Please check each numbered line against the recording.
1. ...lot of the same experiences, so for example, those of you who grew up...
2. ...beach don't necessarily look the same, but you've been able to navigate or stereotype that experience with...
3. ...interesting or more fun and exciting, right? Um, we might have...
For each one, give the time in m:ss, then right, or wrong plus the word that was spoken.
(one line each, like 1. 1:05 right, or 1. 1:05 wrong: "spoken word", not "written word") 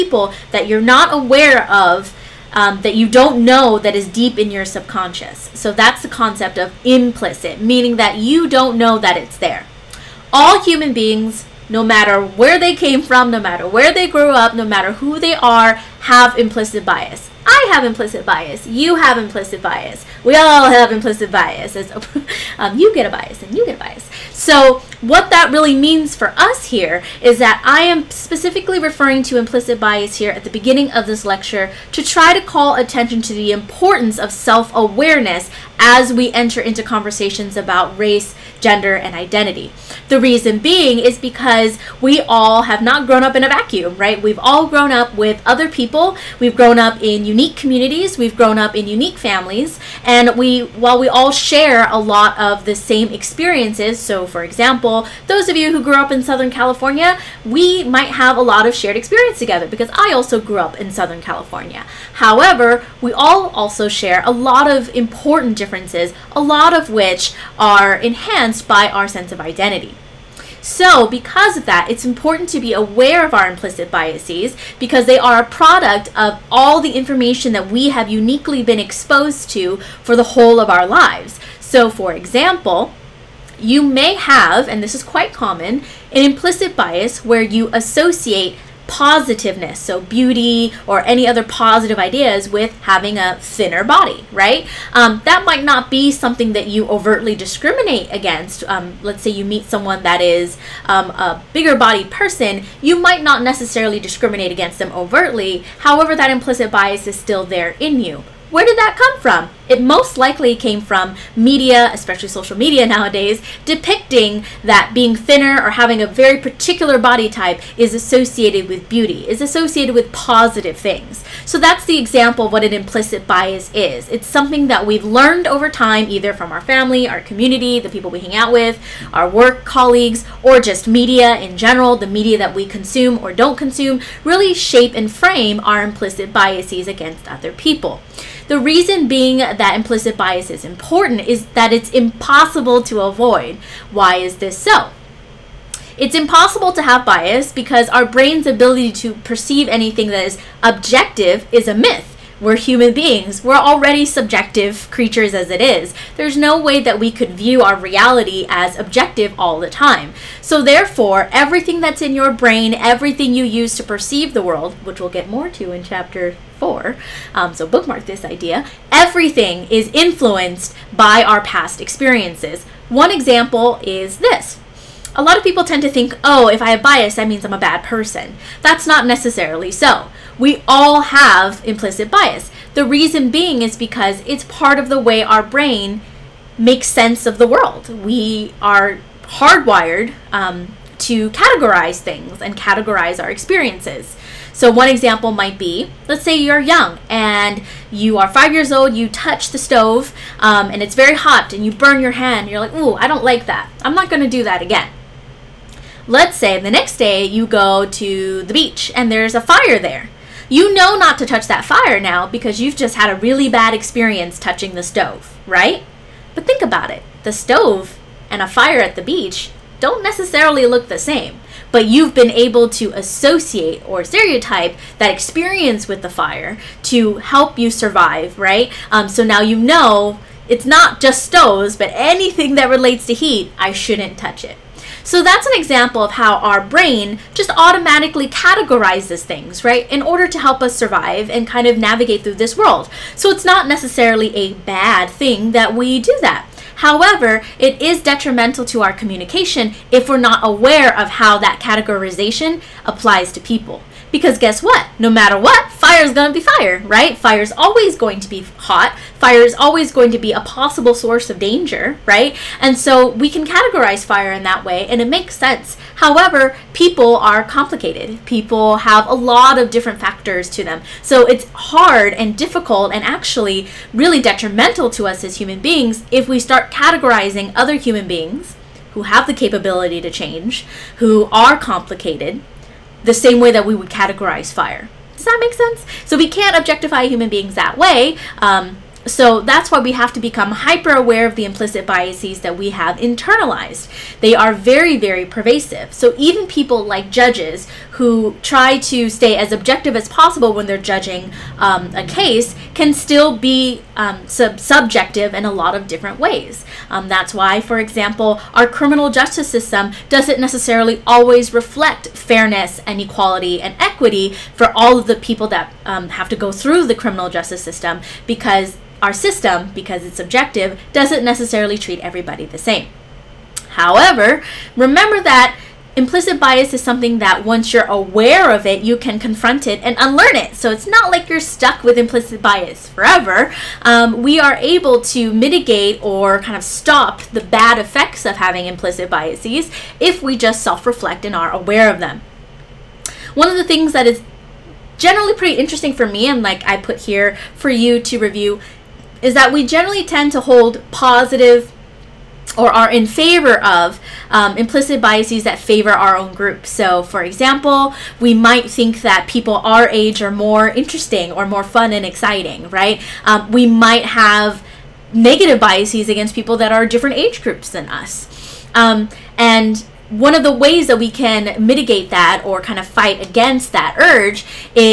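1. 0:51 right
2. 3:39 wrong: "associate", not "navigate"
3. 6:00 right.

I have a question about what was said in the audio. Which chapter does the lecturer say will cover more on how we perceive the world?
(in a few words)
chapter 4.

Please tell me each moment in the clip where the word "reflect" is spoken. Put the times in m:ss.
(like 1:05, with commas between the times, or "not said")
5:11, 5:40.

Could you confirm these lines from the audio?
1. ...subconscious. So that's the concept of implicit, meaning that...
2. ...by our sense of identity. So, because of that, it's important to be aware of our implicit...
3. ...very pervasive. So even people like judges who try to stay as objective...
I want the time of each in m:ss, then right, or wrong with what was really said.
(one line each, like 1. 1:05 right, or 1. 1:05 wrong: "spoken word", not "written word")
1. 0:04 right
2. 1:08 right
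3. 4:54 right.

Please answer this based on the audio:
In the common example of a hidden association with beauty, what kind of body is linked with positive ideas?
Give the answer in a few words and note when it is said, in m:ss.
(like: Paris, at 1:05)
a thinner body, at 1:33.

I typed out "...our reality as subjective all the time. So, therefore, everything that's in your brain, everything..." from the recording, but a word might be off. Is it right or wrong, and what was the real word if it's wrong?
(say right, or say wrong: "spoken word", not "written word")
wrong: "objective", not "subjective".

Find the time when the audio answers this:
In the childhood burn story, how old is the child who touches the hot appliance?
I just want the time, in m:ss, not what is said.
3:18.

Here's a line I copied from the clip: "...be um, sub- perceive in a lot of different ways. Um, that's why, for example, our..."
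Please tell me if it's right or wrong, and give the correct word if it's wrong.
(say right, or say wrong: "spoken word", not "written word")
wrong: "subjective", not "perceive".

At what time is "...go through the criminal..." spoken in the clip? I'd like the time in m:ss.
5:16.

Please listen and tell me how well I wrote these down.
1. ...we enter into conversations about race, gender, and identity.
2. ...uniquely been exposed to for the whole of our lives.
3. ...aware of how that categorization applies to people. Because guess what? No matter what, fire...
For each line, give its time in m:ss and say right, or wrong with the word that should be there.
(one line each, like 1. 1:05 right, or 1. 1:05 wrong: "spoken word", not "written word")
1. 0:36 right
2. 1:18 right
3. 4:10 right.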